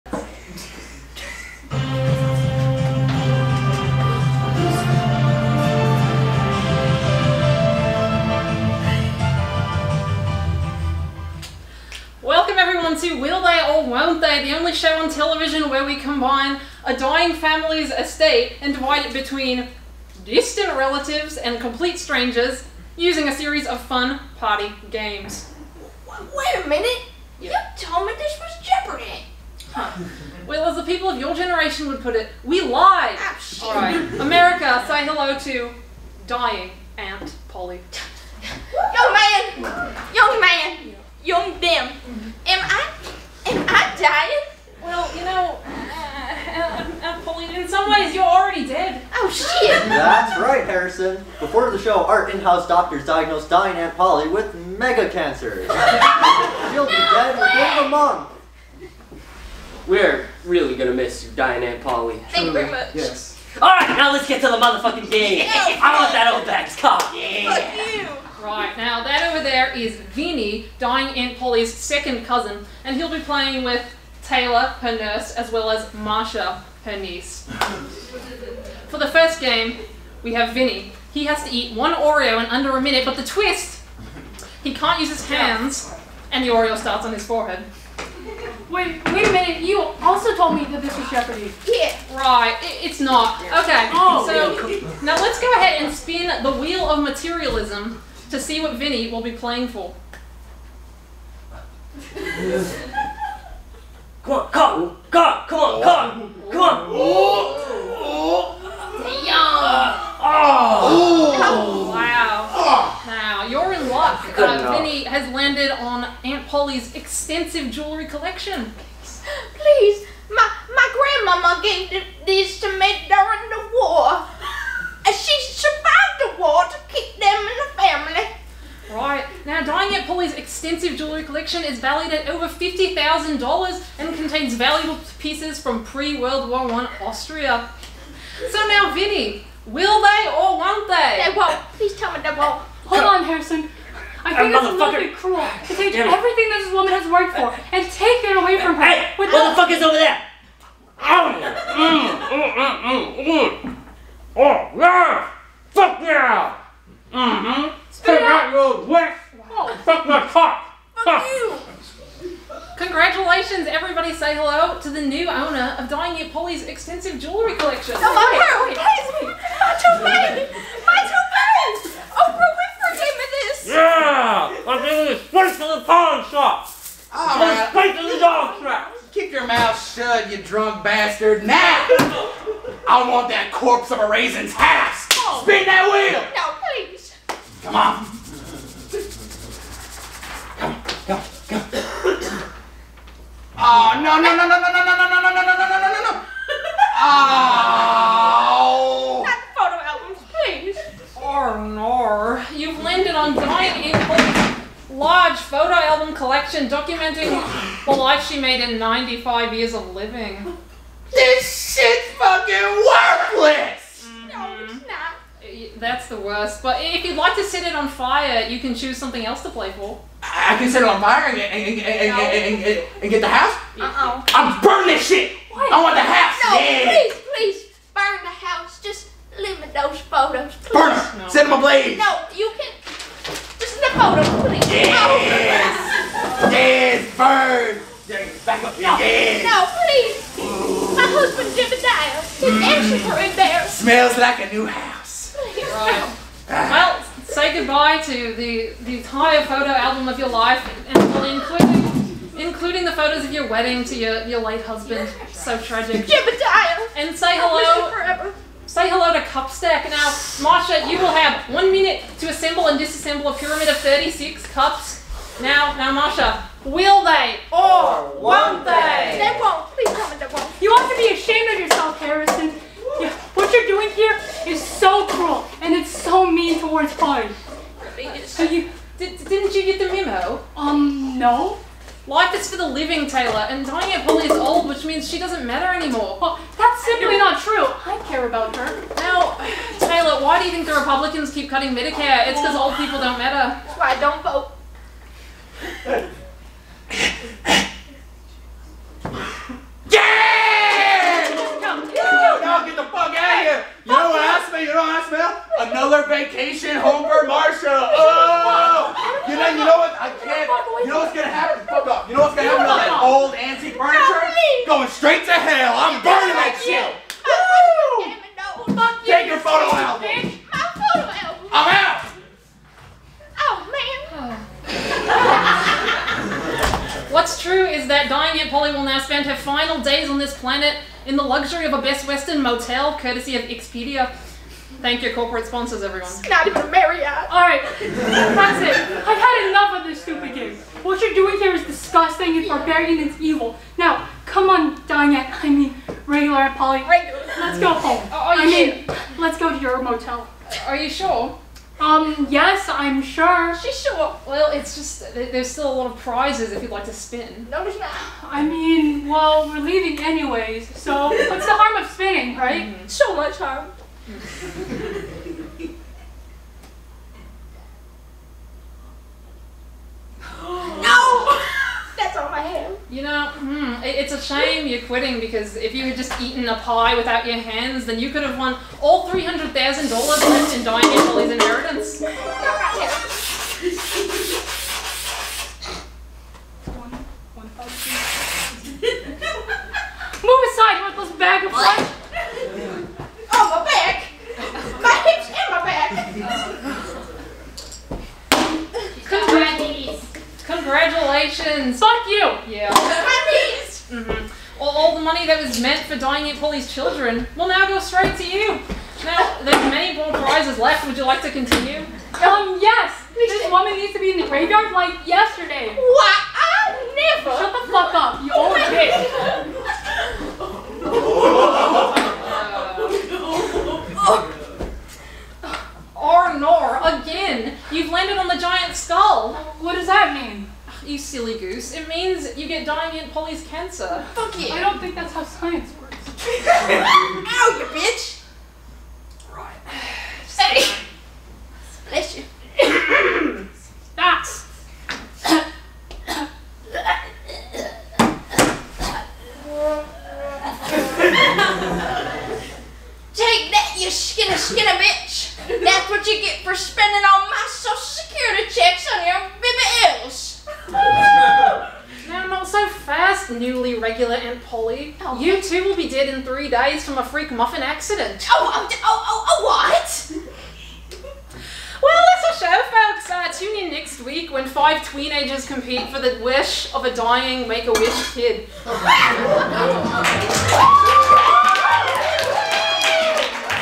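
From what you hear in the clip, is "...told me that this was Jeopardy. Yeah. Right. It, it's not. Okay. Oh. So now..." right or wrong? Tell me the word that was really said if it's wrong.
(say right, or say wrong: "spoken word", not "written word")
right.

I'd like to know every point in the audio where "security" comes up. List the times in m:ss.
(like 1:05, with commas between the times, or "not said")
7:37.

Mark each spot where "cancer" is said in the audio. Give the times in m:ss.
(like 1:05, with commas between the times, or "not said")
0:55, 7:13.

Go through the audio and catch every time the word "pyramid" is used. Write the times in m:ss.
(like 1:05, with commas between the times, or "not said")
4:23.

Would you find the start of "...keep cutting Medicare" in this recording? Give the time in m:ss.
4:51.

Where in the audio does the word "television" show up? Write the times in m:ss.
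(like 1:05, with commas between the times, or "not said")
0:15.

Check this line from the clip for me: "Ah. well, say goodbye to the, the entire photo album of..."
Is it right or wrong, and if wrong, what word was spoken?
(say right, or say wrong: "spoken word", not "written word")
right.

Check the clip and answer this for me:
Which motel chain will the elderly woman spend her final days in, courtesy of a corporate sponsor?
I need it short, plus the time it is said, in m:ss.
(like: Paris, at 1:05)
Best Western, at 5:31.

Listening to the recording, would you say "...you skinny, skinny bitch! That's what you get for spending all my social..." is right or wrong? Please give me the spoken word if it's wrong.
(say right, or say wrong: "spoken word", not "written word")
right.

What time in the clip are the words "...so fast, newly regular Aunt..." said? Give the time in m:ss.
7:42.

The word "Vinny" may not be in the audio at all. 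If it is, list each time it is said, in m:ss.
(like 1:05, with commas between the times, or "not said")
1:09, 1:20, 1:38, 1:54, 2:18.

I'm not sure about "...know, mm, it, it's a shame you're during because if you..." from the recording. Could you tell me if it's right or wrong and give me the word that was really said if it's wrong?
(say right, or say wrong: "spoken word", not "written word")
wrong: "quitting", not "during".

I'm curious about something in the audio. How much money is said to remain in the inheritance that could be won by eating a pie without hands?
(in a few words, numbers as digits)
$300,000.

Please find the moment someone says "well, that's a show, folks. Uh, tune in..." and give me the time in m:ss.
7:51.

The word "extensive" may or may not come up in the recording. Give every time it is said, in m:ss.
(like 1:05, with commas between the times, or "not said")
1:56, 2:10, 2:46.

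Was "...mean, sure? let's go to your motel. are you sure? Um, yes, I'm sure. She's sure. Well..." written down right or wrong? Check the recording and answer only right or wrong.
right.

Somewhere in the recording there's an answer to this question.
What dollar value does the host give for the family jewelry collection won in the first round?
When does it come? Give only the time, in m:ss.
2:12.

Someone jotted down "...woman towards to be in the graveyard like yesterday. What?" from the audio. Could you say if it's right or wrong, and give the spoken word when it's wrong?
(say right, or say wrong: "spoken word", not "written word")
wrong: "needs", not "towards".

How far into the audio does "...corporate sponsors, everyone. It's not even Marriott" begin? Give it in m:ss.
5:35.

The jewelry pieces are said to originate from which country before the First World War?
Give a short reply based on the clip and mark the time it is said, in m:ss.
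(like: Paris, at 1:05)
Austria, at 2:17.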